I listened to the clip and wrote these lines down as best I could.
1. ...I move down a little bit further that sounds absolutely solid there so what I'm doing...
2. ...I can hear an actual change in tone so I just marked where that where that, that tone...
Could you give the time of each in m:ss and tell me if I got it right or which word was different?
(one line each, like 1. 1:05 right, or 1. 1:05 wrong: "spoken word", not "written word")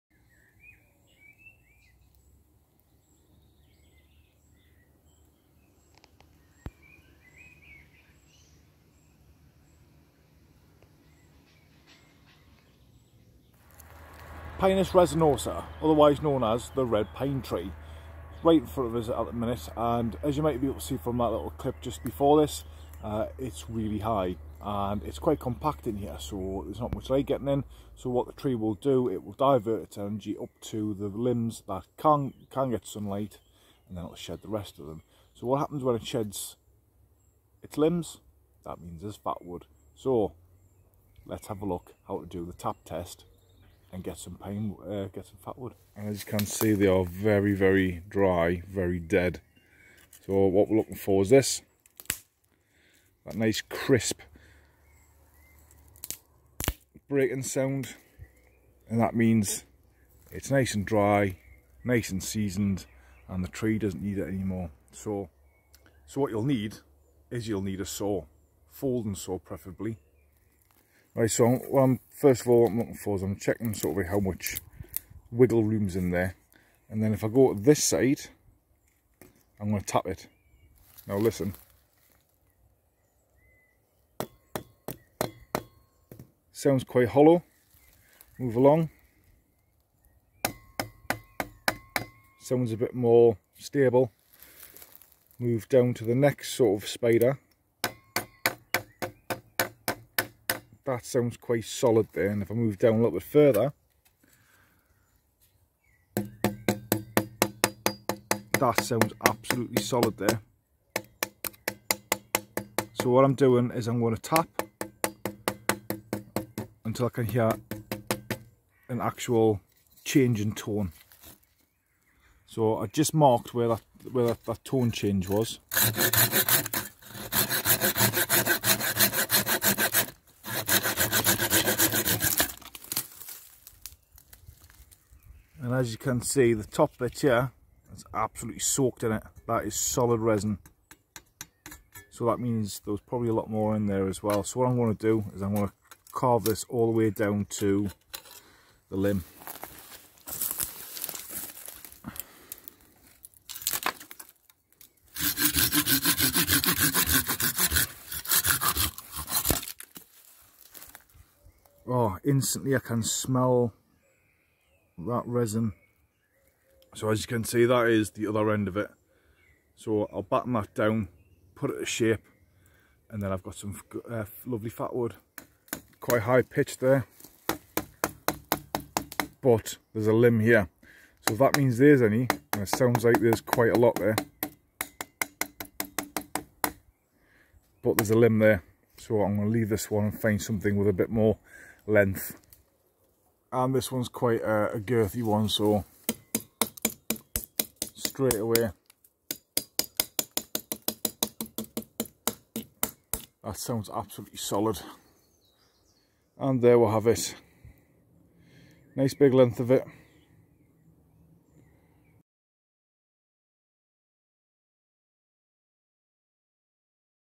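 1. 1:42 right
2. 1:57 right.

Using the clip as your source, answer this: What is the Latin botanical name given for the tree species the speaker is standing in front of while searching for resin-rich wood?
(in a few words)
Pinus resinosa.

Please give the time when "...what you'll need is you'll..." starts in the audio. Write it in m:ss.
1:06.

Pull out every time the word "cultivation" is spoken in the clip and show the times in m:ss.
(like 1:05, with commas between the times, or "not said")
not said.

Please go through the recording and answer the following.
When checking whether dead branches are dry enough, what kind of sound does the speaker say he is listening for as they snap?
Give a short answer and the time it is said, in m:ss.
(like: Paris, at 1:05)
crisp breaking sound, at 0:53.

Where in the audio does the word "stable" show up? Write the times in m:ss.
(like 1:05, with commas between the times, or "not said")
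1:33.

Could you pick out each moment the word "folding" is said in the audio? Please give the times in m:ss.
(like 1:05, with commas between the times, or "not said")
1:08.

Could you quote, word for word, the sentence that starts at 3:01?
So if that means there's any, and it sounds like there's quite a lot there, but there's a limb there.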